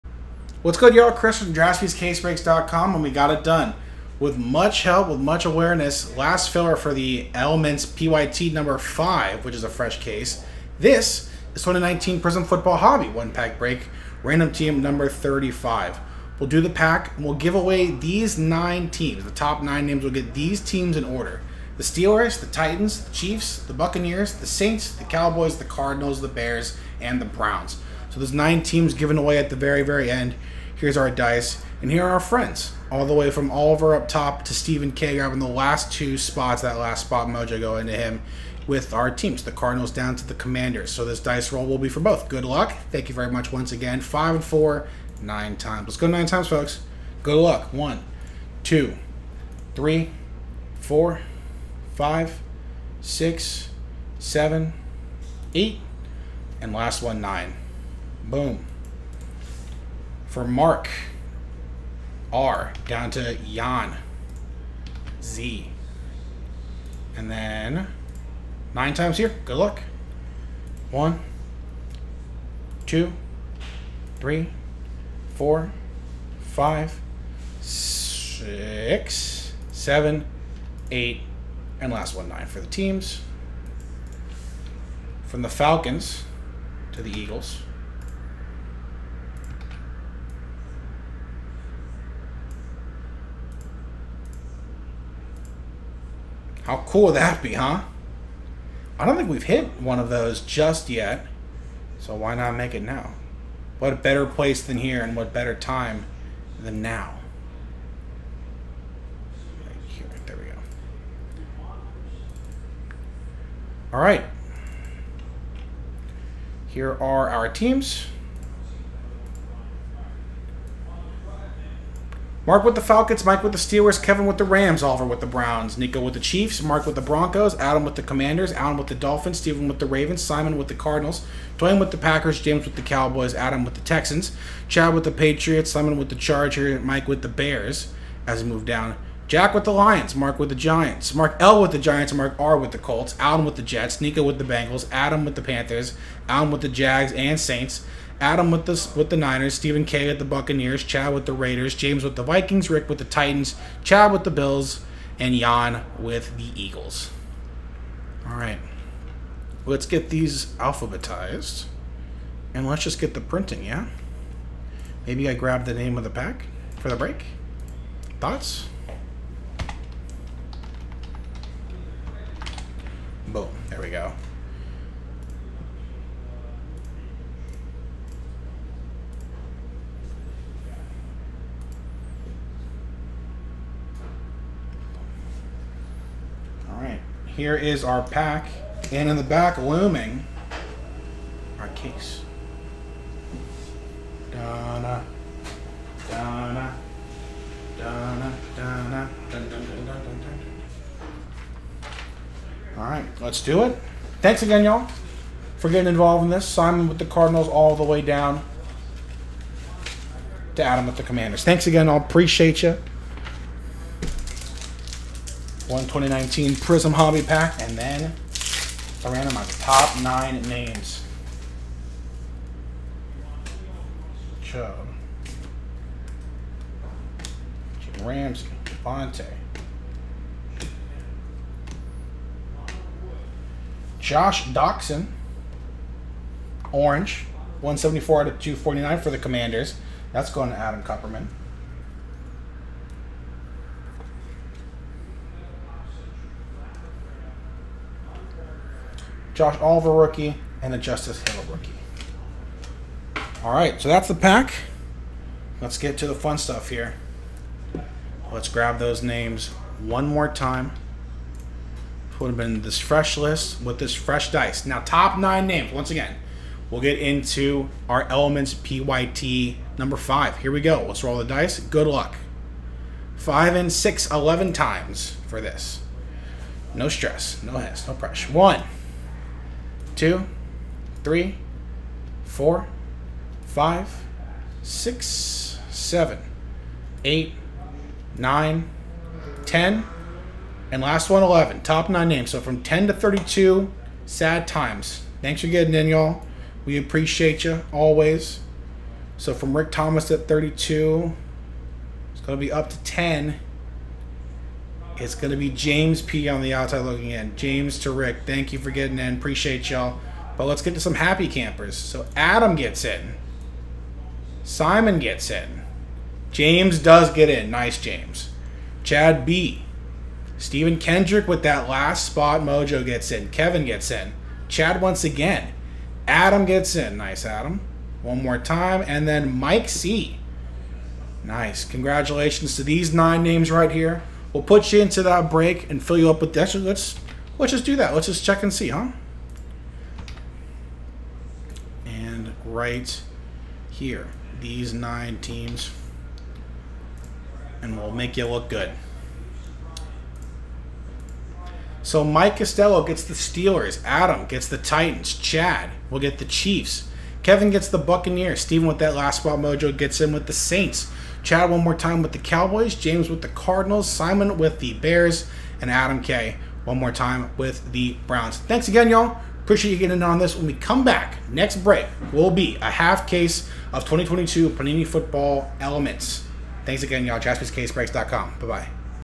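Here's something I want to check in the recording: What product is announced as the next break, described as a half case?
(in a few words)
2022 Panini Football Elements.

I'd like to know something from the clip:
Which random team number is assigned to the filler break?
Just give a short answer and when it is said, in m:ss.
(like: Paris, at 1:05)
35, at 0:14.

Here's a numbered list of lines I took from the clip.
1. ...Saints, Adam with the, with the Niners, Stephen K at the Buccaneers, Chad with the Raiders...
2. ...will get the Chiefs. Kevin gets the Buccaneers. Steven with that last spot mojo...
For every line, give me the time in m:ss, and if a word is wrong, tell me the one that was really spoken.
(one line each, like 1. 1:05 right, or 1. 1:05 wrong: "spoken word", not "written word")
1. 2:27 right
2. 5:55 right.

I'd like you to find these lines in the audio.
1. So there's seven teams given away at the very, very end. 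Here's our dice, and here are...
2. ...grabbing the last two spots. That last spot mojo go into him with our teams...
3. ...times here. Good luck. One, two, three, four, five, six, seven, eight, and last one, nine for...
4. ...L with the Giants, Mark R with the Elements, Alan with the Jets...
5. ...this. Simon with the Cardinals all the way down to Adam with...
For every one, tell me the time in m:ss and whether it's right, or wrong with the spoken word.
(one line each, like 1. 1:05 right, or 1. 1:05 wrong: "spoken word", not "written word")
1. 0:28 wrong: "nine", not "seven"
2. 0:35 right
3. 1:08 right
4. 2:21 wrong: "Colts", not "Elements"
5. 3:26 right.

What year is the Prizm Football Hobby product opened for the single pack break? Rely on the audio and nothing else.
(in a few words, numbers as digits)
2019.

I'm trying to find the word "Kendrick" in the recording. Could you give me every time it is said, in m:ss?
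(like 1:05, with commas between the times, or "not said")
5:20.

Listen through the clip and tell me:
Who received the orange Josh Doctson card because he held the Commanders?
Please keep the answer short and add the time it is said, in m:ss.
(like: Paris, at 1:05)
Adam Kupperman, at 4:00.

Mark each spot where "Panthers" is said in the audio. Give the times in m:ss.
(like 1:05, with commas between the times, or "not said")
2:25.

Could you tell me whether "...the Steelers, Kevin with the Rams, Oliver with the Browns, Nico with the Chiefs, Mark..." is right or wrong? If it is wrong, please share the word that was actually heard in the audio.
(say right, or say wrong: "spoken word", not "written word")
right.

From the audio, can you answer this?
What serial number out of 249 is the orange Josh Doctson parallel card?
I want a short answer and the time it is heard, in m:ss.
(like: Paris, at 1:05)
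174, at 3:57.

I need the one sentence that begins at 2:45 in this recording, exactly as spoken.
Maybe I grab the name of the pack for the break.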